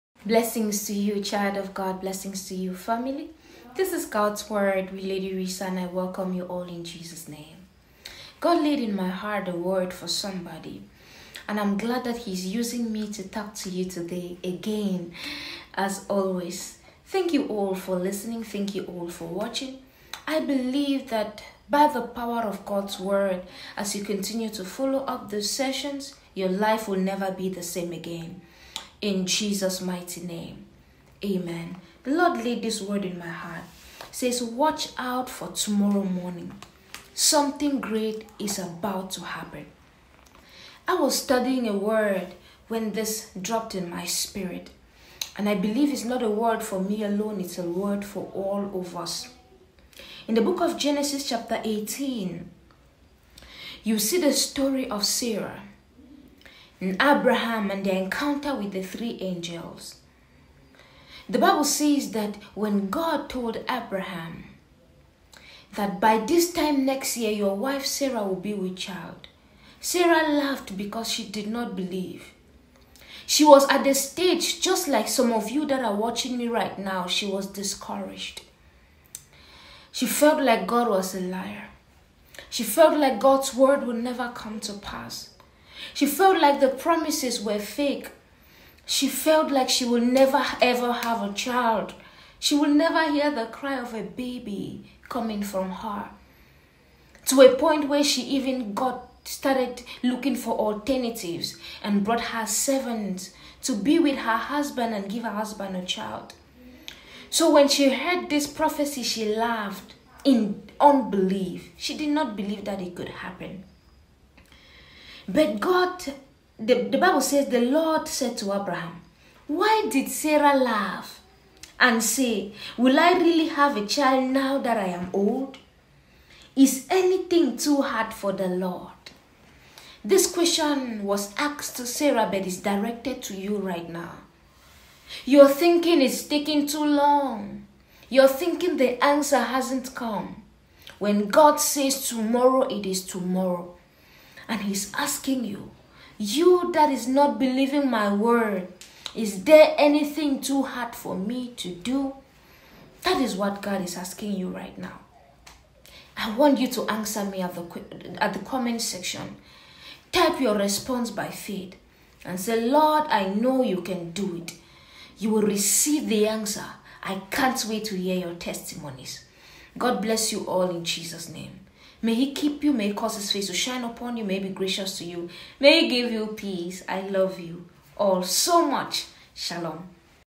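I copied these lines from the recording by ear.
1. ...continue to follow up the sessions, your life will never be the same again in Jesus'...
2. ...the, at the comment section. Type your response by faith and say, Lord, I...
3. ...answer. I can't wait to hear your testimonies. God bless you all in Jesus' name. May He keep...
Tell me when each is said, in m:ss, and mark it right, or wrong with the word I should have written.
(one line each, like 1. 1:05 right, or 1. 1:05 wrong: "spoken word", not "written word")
1. 0:24 right
2. 2:37 right
3. 2:46 right.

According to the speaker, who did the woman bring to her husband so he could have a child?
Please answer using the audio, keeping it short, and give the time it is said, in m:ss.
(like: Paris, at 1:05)
Her servant, at 1:42.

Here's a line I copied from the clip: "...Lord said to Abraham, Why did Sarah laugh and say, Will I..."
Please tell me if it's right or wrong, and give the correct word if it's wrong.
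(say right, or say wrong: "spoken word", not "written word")
right.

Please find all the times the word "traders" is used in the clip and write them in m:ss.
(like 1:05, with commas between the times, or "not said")
not said.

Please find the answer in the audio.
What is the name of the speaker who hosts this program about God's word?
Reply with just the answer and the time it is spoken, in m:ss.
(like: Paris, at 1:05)
Lady Risa, at 0:05.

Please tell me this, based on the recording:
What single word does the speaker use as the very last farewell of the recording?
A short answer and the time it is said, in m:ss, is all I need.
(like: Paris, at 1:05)
Shalom, at 2:59.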